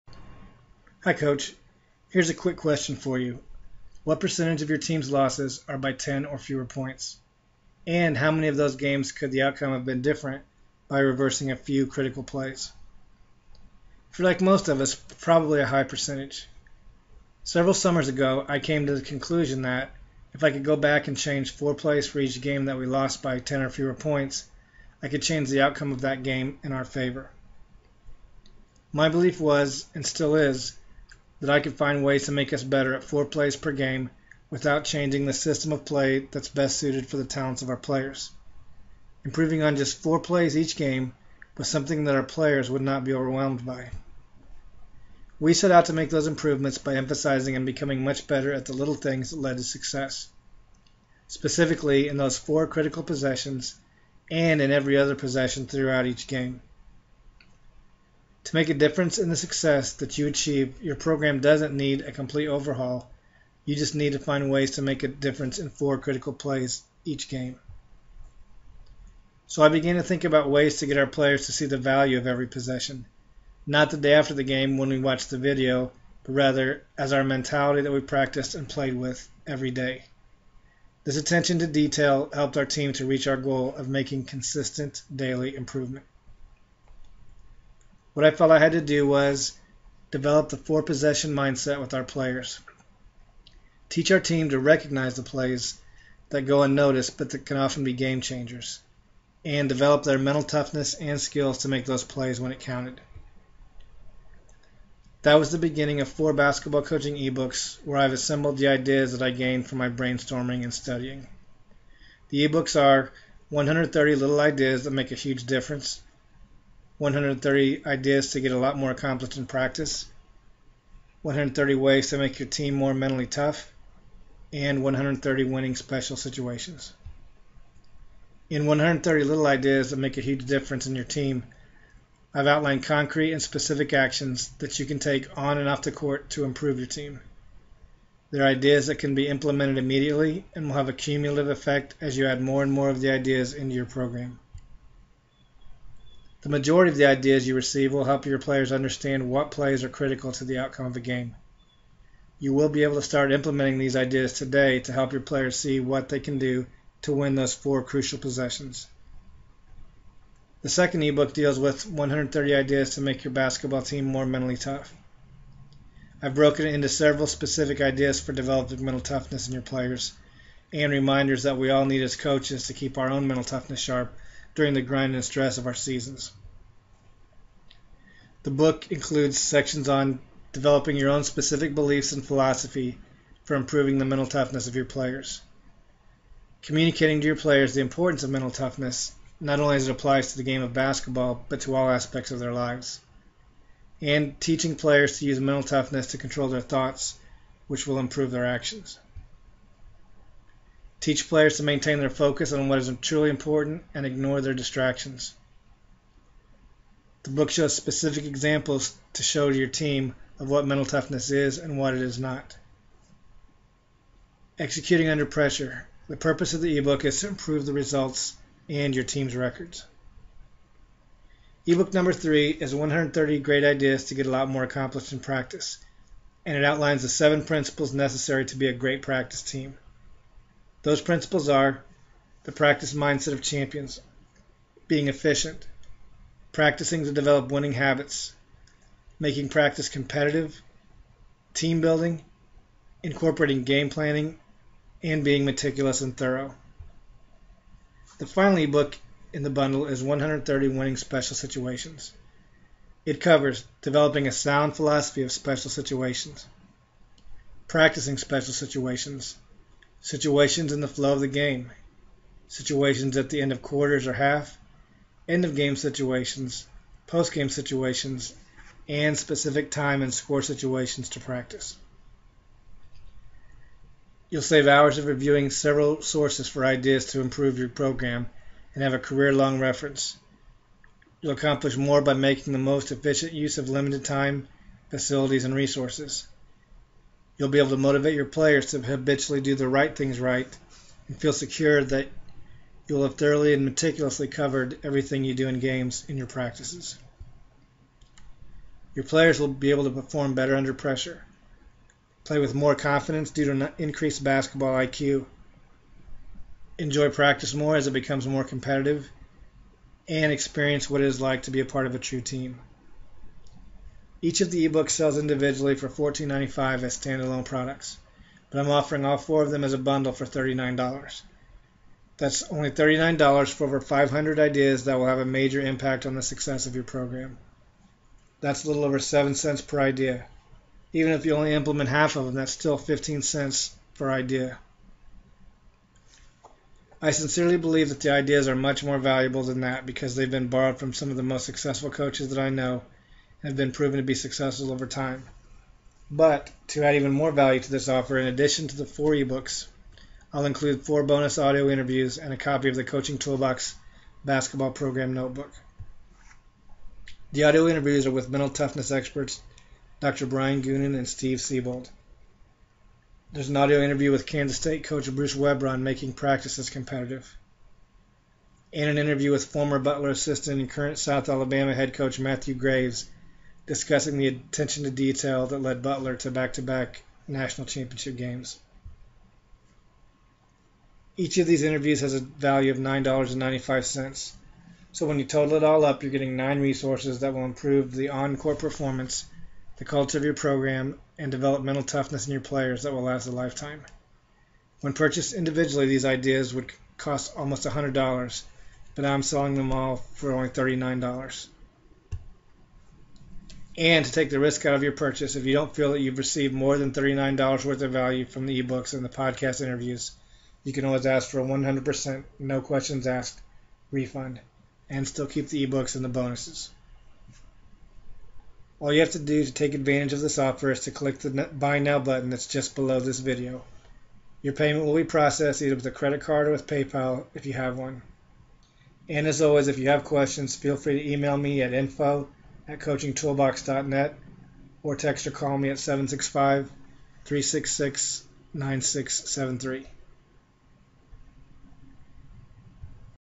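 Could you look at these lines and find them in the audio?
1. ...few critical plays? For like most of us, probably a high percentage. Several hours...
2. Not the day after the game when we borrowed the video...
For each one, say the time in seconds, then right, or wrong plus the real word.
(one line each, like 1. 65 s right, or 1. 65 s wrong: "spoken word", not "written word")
1. 11 s wrong: "summers", not "hours"
2. 73 s wrong: "watched", not "borrowed".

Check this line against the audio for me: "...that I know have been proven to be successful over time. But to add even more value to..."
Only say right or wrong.
right.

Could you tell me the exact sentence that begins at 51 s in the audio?
Specifically, in those four critical possessions and in every other possession throughout each game.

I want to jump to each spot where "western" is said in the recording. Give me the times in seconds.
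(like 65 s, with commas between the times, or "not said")
not said.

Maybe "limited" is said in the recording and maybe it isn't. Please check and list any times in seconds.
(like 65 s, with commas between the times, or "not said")
283 s.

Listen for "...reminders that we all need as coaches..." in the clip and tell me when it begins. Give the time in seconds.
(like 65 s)
170 s.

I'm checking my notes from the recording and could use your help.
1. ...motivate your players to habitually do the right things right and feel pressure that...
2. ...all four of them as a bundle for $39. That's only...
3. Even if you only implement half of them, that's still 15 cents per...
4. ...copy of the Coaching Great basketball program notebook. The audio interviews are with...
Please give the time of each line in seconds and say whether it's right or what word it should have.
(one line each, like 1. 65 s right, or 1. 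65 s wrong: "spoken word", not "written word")
1. 287 s wrong: "secure", not "pressure"
2. 319 s right
3. 330 s right
4. 352 s wrong: "Toolbox", not "Great".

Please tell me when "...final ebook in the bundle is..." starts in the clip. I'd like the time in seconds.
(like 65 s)
248 s.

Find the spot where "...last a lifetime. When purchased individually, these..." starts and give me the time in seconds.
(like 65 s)
393 s.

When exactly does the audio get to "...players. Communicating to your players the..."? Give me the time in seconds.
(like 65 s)
184 s.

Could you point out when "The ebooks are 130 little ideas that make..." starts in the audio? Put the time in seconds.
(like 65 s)
112 s.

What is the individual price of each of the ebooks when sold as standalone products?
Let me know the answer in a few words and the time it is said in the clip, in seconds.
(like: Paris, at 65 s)
$14.95, at 315 s.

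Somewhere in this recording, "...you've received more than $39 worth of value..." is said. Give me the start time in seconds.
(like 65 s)
406 s.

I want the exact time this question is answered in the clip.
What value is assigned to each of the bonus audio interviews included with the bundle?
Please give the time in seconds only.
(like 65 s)
382 s.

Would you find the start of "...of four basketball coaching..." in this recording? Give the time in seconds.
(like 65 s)
106 s.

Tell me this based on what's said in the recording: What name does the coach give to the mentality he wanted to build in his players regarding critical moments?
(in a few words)
four possession mindset.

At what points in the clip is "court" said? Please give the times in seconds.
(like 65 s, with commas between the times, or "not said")
135 s, 388 s.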